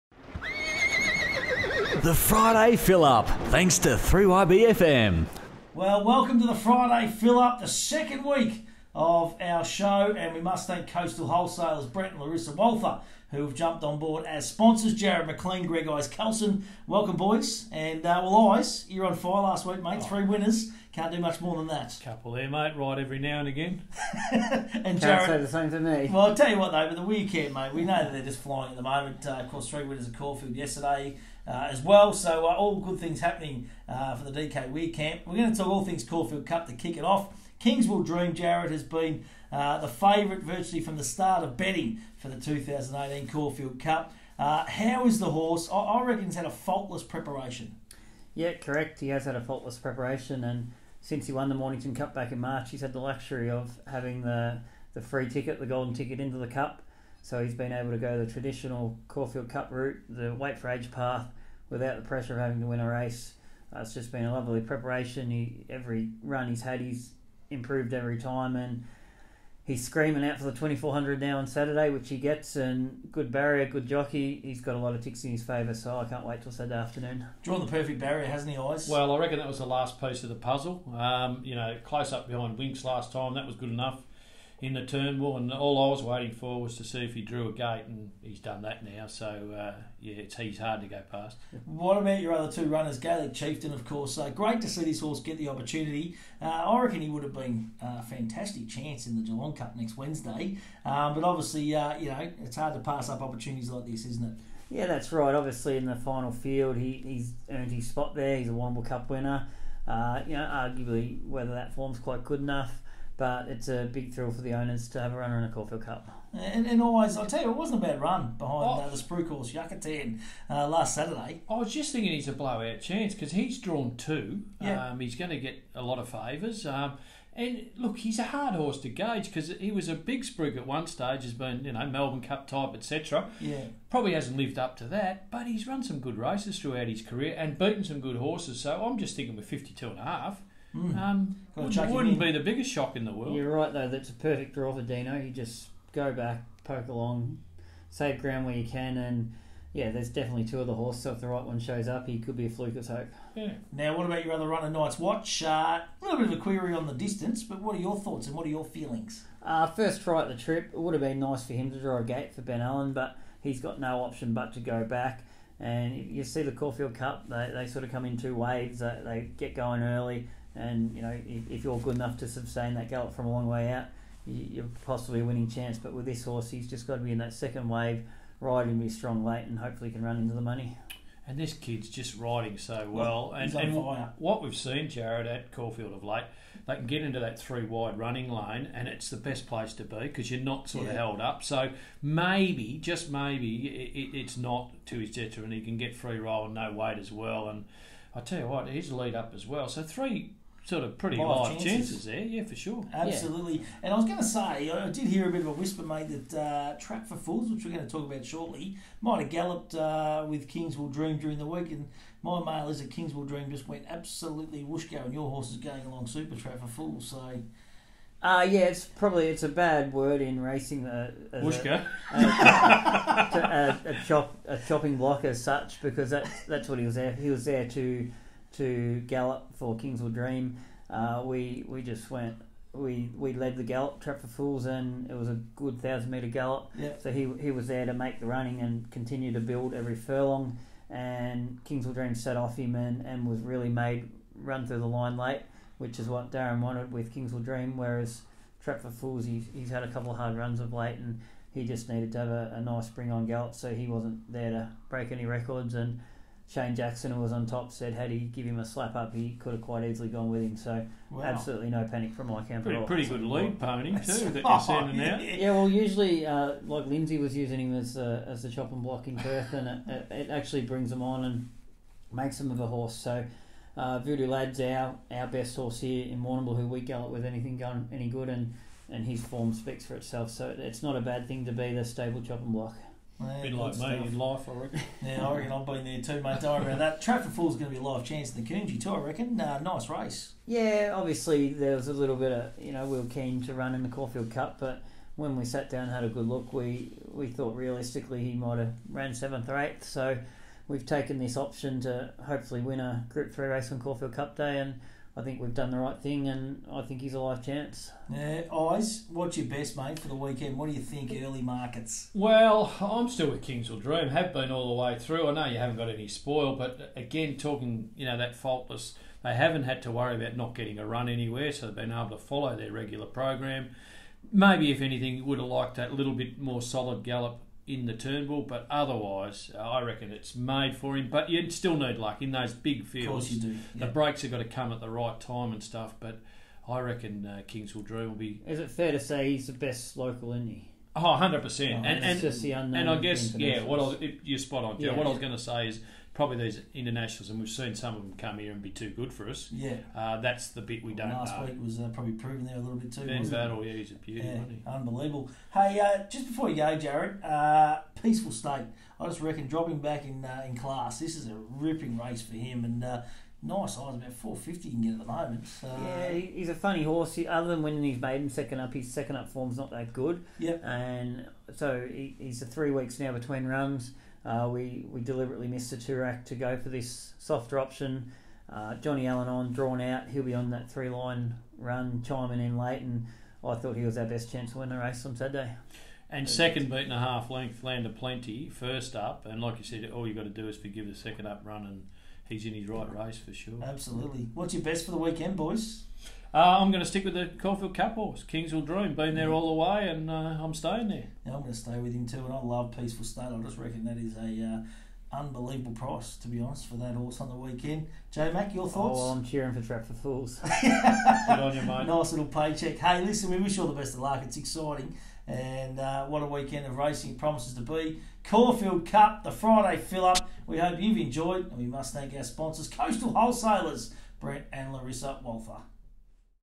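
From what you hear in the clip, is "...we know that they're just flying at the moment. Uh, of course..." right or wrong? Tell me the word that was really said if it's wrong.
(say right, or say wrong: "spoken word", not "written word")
right.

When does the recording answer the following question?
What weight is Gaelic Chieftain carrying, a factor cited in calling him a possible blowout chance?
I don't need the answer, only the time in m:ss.
2:19.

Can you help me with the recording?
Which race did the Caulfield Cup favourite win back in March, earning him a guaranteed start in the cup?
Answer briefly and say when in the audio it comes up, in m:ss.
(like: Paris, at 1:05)
Mornington Cup, at 0:51.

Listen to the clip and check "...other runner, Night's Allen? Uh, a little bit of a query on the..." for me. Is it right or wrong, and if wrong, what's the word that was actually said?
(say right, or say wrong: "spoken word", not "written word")
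wrong: "Watch", not "Allen".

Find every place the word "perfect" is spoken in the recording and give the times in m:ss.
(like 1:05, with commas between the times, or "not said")
1:17, 2:24.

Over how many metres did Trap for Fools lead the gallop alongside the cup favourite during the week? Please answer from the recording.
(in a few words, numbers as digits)
1000.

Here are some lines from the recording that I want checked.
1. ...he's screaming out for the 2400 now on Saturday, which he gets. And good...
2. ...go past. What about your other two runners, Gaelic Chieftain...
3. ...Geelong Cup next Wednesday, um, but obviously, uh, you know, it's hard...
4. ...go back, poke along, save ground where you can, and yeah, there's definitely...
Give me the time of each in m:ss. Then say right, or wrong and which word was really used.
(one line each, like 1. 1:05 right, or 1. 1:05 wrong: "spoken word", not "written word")
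1. 1:09 right
2. 1:30 right
3. 1:39 right
4. 2:25 right.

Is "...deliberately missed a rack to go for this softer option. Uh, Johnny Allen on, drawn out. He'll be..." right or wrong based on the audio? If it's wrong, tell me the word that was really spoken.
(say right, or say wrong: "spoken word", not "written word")
right.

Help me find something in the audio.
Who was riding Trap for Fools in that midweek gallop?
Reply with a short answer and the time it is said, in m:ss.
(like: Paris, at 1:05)
Shane Jackson, at 4:16.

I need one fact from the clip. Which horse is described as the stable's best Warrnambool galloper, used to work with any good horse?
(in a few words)
Voodoo Lad.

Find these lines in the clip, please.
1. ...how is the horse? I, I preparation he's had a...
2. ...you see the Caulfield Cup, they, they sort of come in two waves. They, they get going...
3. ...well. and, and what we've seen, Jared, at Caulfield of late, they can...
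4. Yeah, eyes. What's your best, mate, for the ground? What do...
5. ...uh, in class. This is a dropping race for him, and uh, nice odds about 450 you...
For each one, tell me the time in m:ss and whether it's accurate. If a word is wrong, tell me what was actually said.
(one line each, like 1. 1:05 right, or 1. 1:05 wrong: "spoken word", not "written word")
1. 0:44 wrong: "reckon", not "preparation"
2. 2:45 right
3. 3:02 right
4. 5:08 wrong: "weekend", not "ground"
5. 6:00 wrong: "ripping", not "dropping".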